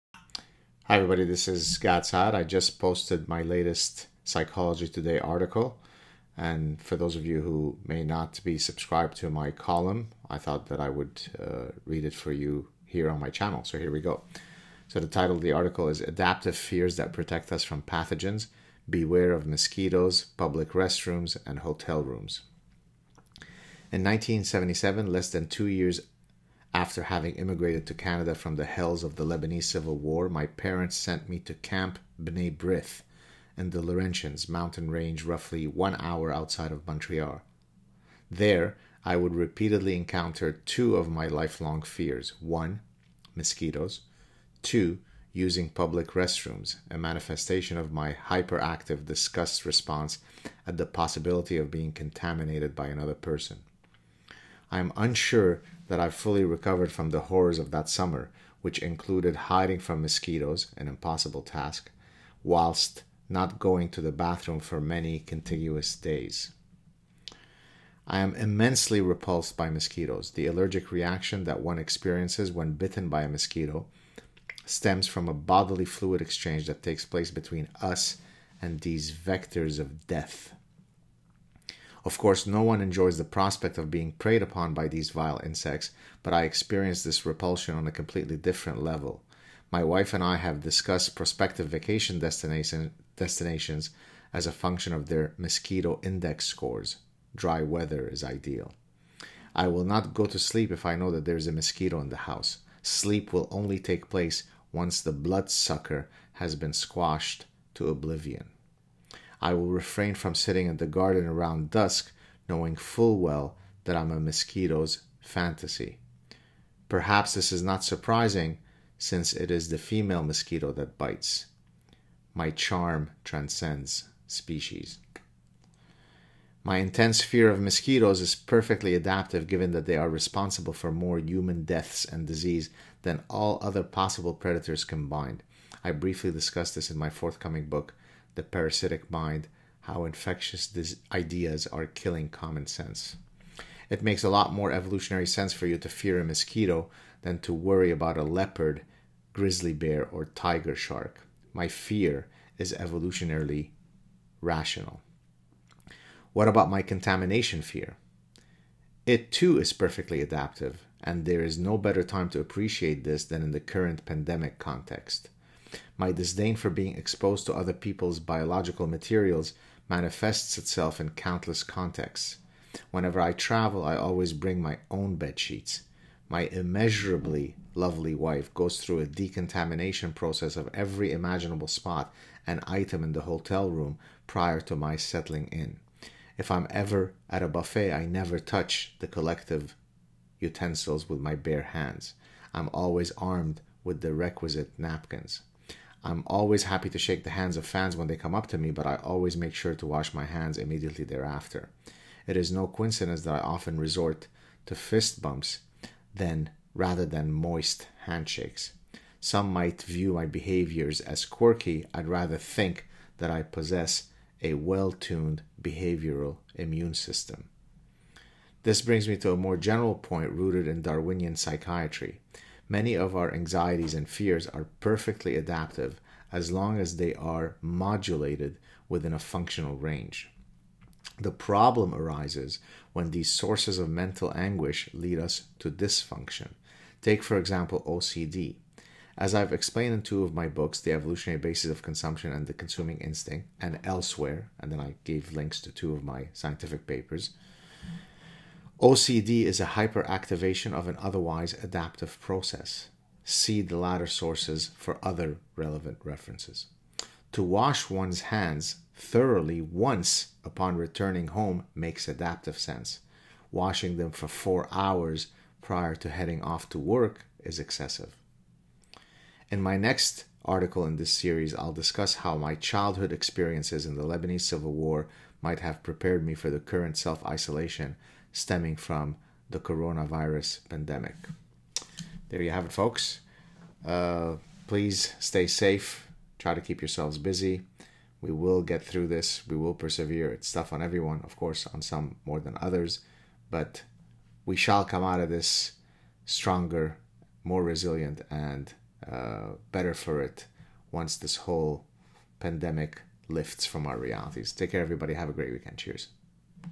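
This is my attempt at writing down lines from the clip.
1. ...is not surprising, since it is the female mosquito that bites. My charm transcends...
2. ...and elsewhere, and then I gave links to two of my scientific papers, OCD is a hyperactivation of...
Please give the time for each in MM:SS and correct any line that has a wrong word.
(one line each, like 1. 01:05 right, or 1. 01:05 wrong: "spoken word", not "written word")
1. 01:57 right
2. 04:03 right.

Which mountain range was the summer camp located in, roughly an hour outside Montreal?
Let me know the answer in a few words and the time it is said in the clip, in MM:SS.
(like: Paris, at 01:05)
Laurentians, at 00:33.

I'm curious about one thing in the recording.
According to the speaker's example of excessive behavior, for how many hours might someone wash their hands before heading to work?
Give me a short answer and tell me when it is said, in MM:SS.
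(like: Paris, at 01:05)
4, at 04:24.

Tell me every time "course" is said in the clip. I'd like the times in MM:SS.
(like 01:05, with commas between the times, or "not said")
01:22, 04:51.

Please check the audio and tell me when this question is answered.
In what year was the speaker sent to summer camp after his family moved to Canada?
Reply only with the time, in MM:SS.
00:24.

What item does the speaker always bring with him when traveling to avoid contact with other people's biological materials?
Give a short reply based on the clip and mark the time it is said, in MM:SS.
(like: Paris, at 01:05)
bed sheets, at 02:55.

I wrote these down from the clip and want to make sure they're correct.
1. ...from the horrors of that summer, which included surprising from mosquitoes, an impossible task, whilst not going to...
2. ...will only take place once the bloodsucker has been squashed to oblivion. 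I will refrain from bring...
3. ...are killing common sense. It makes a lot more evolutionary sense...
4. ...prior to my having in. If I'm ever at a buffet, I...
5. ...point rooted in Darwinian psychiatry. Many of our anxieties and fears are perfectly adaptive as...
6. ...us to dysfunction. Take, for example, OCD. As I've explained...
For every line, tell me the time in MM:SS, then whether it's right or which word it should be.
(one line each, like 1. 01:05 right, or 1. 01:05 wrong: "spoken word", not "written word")
1. 00:56 wrong: "hiding", not "surprising"
2. 01:43 wrong: "sitting", not "bring"
3. 02:21 right
4. 03:04 wrong: "settling", not "having"
5. 03:39 right
6. 03:55 right.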